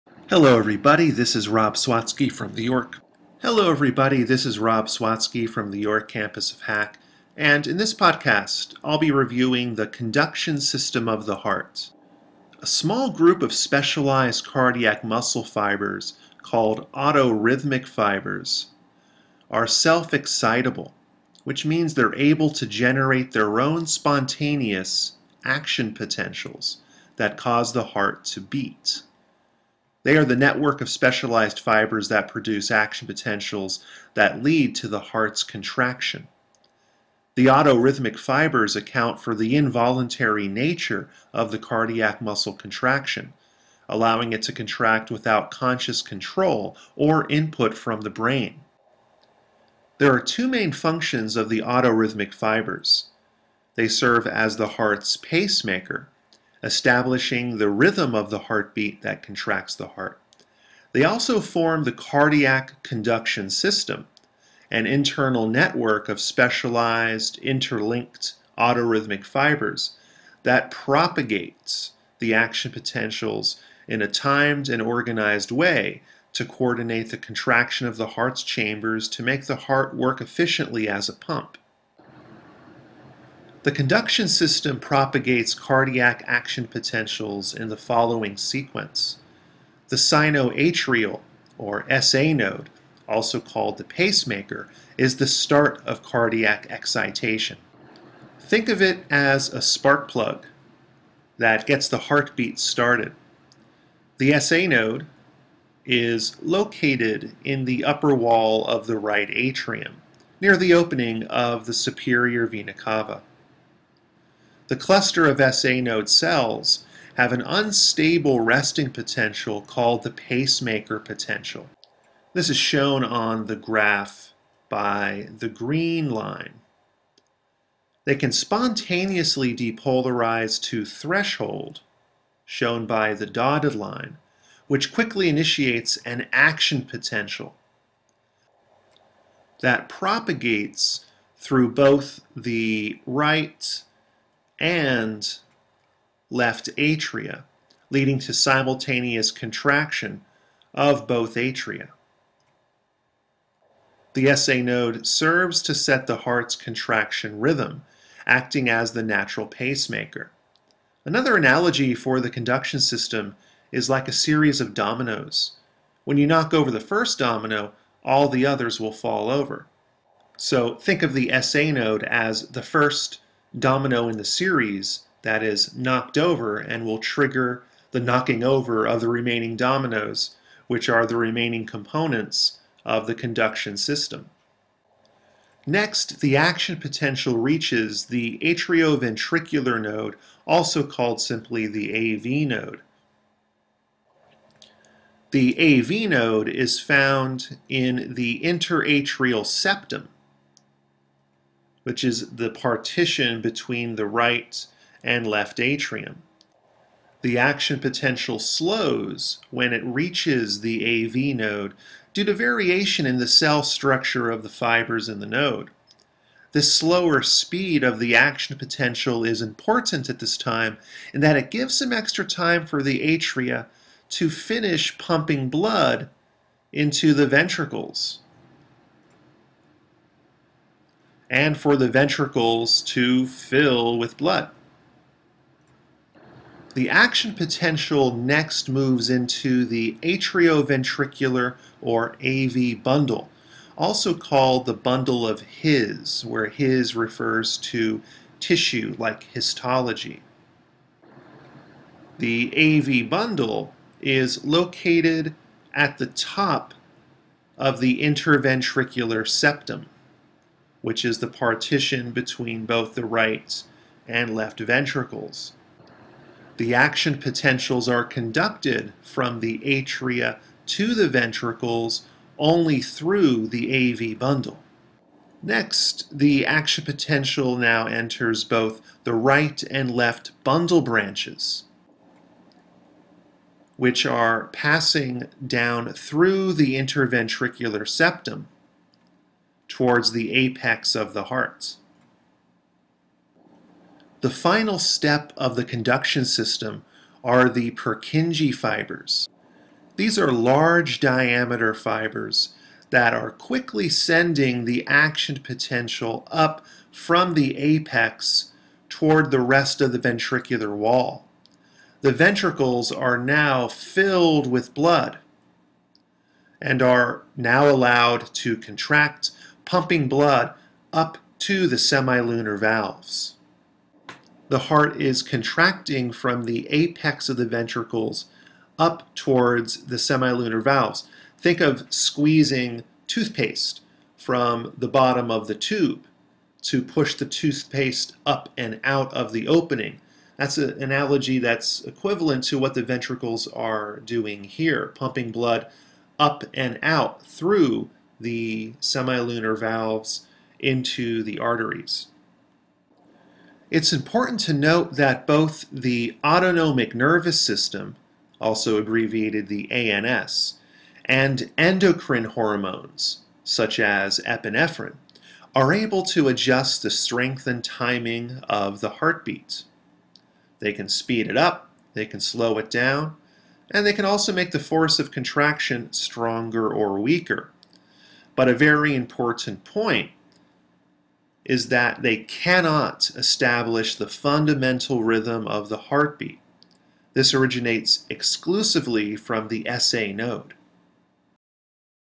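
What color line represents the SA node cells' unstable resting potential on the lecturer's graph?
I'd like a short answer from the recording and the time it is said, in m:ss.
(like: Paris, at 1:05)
Green, at 2:05.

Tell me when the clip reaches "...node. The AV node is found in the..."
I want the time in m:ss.
3:12.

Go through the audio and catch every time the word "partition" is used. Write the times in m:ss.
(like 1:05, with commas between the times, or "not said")
3:22, 4:21.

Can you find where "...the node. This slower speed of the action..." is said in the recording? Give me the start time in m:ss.
3:35.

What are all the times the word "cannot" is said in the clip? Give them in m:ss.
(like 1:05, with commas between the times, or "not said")
6:22.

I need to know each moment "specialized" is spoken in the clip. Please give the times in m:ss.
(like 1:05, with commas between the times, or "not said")
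0:13, 0:30, 1:06.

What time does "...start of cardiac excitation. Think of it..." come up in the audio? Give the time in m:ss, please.
1:35.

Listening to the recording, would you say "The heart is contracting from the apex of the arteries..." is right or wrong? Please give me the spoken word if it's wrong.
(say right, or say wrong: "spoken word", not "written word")
wrong: "ventricles", not "arteries".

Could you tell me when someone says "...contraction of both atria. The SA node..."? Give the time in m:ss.
2:29.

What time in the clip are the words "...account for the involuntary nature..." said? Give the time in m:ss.
0:38.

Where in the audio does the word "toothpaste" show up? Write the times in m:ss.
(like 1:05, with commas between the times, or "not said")
5:33, 5:37.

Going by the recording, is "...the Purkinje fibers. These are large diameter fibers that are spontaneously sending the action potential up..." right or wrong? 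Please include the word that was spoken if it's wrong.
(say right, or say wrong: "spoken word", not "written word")
wrong: "quickly", not "spontaneously".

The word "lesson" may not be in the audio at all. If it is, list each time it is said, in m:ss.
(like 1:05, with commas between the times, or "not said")
not said.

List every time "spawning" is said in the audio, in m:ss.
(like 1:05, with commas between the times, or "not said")
not said.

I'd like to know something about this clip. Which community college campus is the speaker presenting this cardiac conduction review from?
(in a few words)
York campus of HACC.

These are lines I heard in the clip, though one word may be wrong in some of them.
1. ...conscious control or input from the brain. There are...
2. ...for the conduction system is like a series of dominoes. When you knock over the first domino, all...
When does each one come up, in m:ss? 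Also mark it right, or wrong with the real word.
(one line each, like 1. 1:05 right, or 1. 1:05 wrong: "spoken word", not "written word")
1. 0:45 right
2. 2:41 right.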